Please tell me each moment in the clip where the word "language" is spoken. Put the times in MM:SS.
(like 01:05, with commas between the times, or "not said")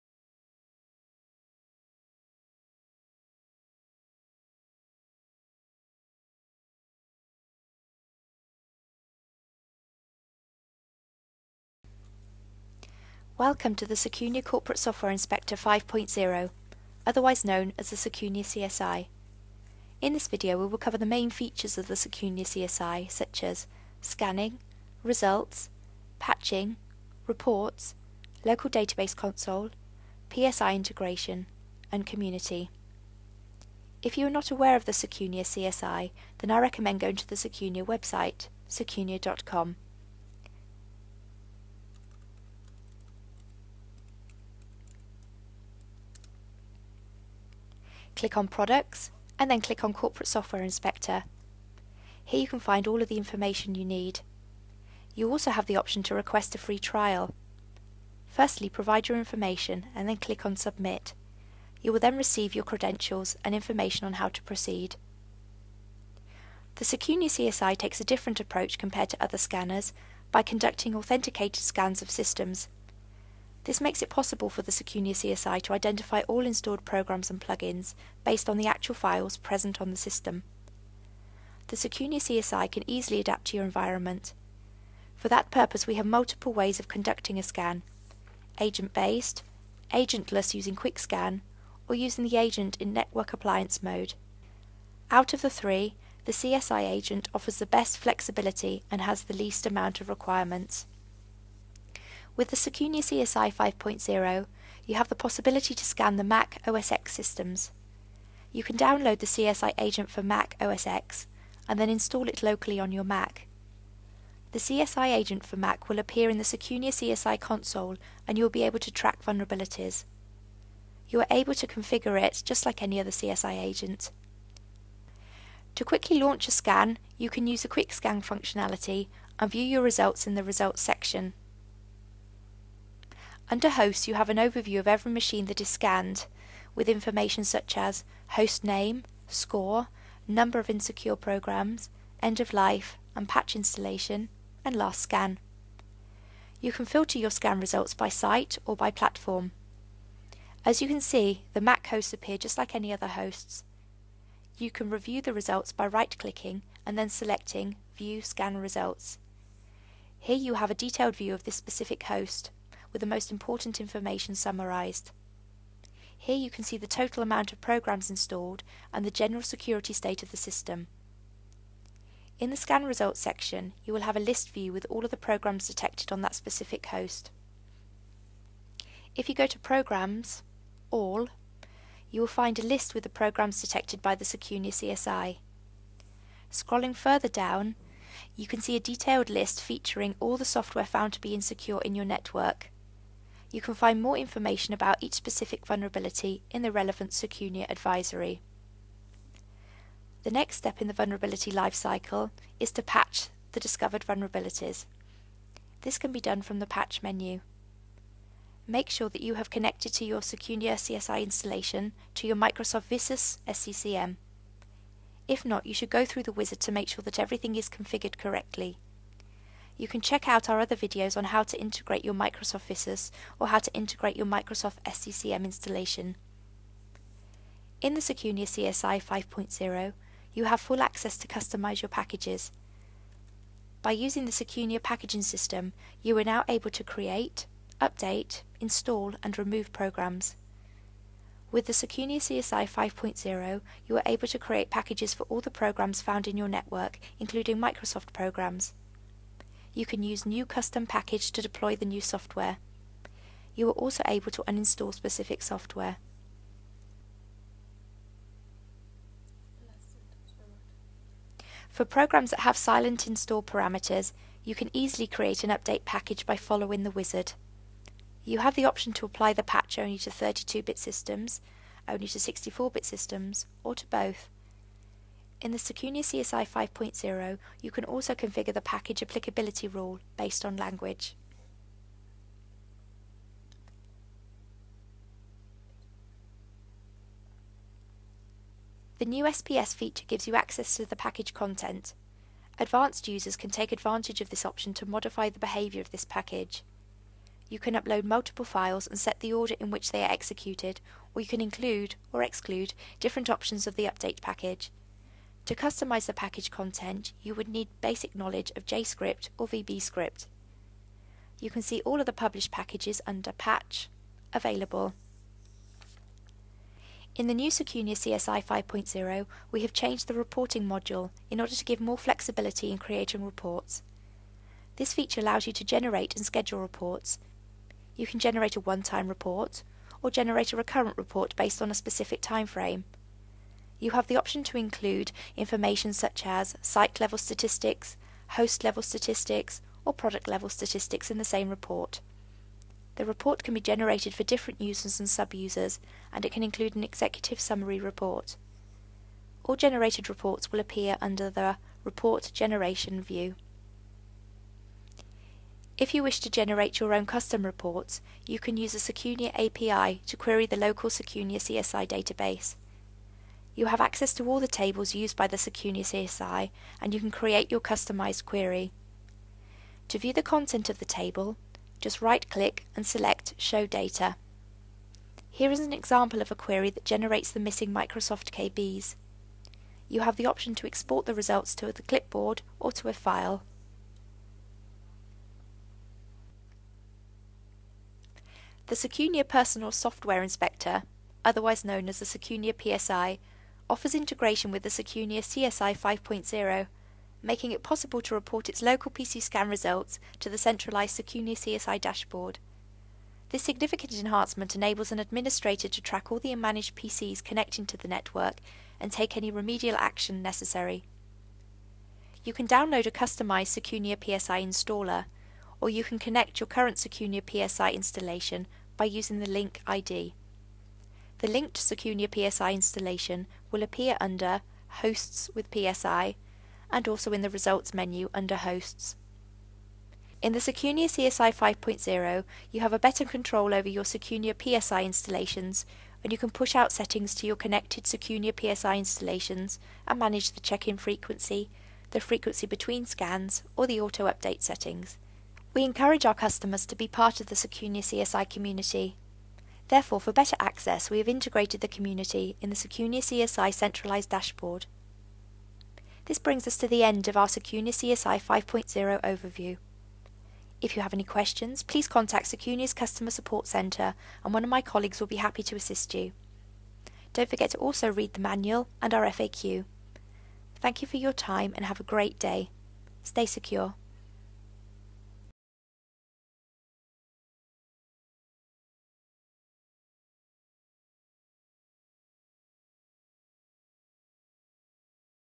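04:40.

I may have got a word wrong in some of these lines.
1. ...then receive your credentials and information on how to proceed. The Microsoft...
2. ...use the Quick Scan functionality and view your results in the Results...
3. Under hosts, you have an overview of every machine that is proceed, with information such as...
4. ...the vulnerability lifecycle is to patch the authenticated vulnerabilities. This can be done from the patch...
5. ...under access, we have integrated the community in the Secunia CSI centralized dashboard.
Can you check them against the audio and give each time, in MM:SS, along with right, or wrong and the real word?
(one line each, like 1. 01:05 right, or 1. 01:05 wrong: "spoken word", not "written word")
1. 01:01 wrong: "Secunia", not "Microsoft"
2. 02:07 right
3. 02:13 wrong: "scanned", not "proceed"
4. 03:20 wrong: "discovered", not "authenticated"
5. 07:30 wrong: "better", not "under".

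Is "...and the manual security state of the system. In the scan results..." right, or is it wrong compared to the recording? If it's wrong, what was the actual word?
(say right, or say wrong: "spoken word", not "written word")
wrong: "general", not "manual".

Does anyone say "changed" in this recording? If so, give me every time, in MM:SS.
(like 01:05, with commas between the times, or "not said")
05:19.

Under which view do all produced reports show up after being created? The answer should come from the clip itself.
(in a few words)
Report Generation.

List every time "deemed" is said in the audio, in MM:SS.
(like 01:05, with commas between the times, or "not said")
not said.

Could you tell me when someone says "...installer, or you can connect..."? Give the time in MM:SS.
06:54.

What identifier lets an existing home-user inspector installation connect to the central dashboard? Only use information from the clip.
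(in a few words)
link ID.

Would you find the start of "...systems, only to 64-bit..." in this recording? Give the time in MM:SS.
04:30.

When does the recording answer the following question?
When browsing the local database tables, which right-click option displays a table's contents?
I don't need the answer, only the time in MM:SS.
06:13.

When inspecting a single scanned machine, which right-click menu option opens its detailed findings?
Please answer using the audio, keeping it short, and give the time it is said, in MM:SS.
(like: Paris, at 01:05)
View Scan Results, at 02:37.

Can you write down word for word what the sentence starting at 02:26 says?
You can filter your scan results by site or by platform.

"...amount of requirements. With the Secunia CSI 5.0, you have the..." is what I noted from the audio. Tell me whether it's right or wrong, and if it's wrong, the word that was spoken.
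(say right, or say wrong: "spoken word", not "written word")
right.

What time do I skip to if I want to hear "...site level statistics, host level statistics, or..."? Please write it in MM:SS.
05:36.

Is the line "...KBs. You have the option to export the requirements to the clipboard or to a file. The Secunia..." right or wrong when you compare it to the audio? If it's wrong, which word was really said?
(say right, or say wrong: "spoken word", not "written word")
wrong: "results", not "requirements".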